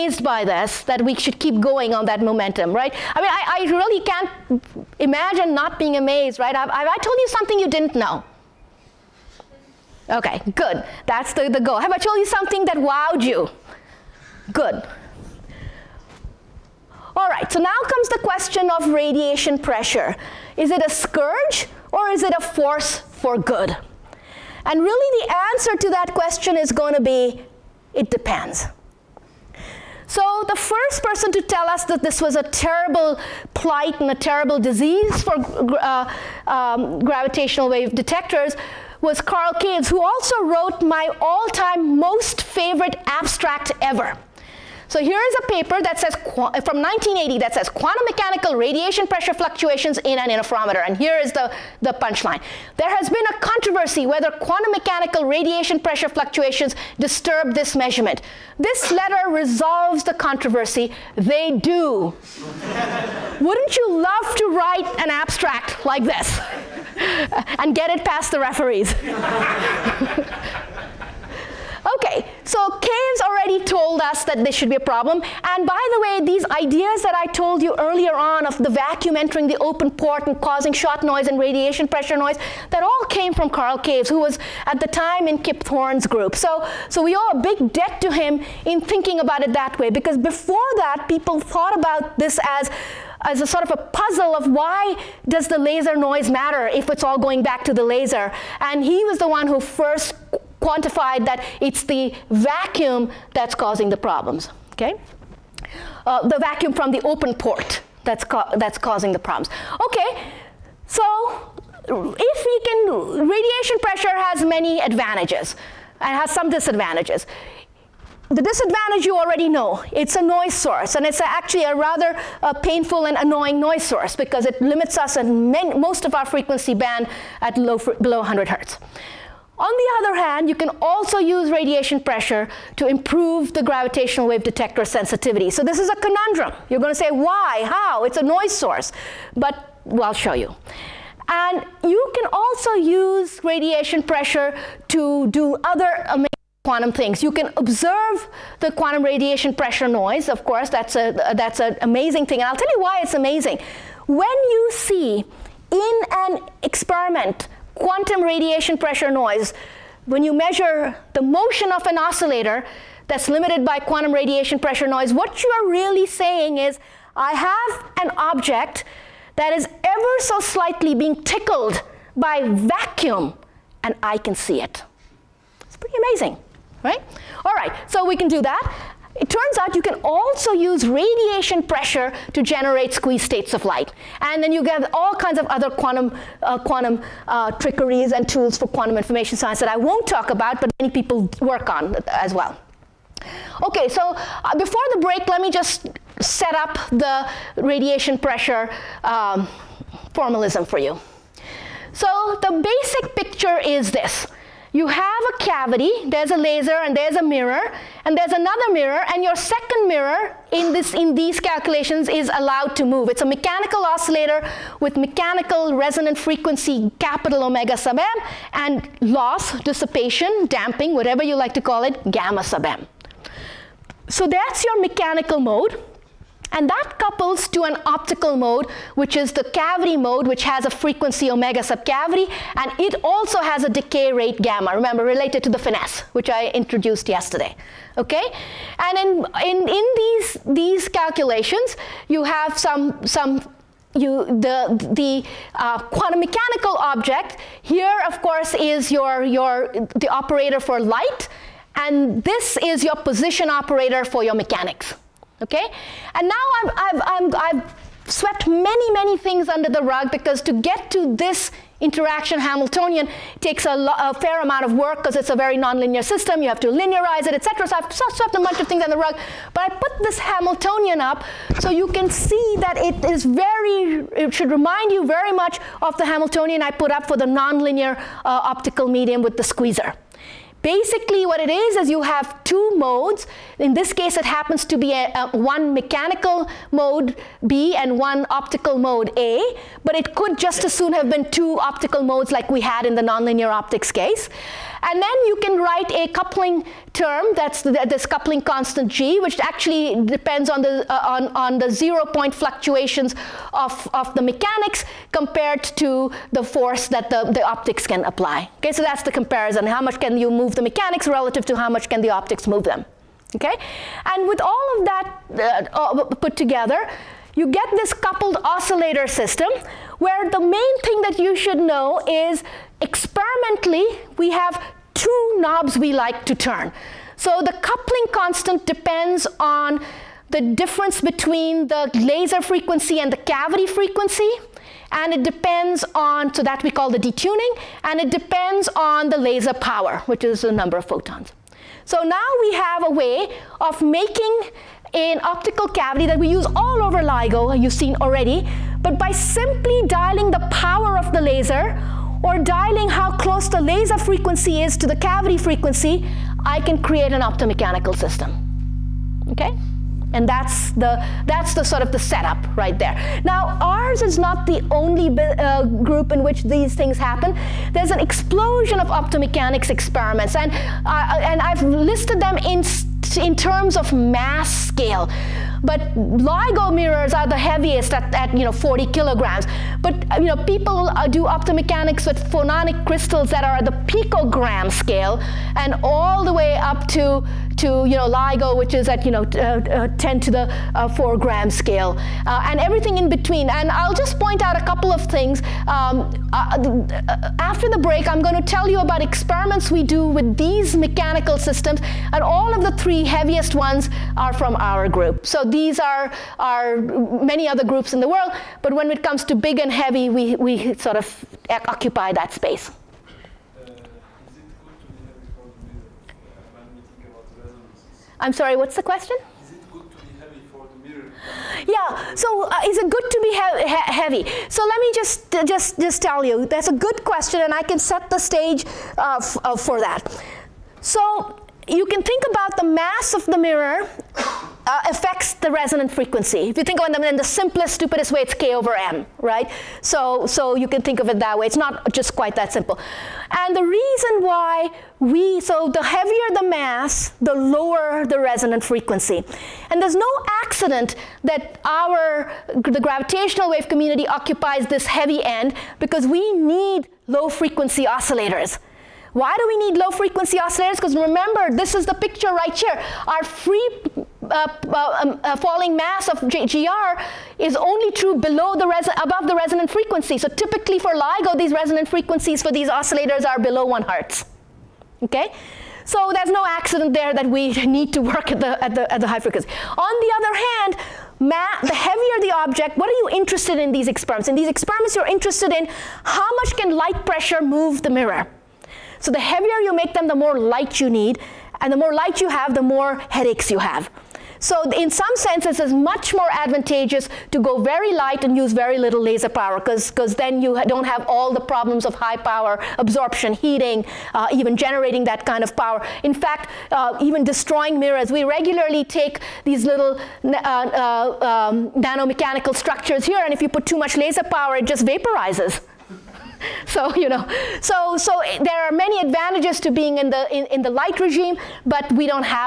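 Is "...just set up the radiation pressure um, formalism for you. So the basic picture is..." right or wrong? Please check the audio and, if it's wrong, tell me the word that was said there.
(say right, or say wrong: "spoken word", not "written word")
right.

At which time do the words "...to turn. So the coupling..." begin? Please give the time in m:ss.
5:26.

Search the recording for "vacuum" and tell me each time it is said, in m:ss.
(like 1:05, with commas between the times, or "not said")
1:18, 1:42, 1:46, 2:52.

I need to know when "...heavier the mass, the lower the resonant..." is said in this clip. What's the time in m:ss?
7:25.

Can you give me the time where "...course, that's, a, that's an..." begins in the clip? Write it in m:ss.
2:30.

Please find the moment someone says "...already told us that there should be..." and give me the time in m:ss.
1:13.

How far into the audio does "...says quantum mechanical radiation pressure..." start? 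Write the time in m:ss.
0:47.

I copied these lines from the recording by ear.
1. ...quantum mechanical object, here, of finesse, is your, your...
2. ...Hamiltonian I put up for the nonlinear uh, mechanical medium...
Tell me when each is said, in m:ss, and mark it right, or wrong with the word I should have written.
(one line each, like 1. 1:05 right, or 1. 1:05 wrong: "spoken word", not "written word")
1. 4:05 wrong: "course", not "finesse"
2. 4:36 wrong: "optical", not "mechanical".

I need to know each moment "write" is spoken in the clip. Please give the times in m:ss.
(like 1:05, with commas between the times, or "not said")
1:04, 4:55.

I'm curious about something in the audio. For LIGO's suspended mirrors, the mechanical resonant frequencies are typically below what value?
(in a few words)
1 hertz.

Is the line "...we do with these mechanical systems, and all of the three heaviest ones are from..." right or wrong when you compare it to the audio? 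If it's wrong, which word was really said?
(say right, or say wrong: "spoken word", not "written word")
right.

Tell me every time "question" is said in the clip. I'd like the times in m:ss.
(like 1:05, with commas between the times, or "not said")
0:18, 0:26, 6:58, 7:07.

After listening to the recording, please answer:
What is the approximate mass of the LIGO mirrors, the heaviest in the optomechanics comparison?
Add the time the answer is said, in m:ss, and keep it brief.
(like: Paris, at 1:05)
40 kilograms, at 6:18.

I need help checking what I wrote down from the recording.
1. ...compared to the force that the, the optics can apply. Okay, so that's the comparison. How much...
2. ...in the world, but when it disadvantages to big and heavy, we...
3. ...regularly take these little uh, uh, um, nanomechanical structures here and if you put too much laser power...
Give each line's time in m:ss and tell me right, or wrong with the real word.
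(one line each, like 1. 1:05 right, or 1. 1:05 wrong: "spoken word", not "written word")
1. 5:05 right
2. 6:47 wrong: "comes", not "disadvantages"
3. 8:28 right.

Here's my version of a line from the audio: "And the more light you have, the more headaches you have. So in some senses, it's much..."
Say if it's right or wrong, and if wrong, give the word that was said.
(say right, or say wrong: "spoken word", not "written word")
right.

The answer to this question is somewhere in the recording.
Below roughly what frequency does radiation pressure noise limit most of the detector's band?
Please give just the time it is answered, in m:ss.
2:08.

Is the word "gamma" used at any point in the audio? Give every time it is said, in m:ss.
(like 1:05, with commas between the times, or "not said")
3:42, 3:54.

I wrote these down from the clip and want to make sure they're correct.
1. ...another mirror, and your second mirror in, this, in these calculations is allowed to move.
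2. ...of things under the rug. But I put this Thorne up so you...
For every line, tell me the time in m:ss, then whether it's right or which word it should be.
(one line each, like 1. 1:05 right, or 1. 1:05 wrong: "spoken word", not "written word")
1. 3:28 right
2. 4:28 wrong: "Hamiltonian", not "Thorne".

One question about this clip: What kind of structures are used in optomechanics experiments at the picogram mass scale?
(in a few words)
phononic crystals.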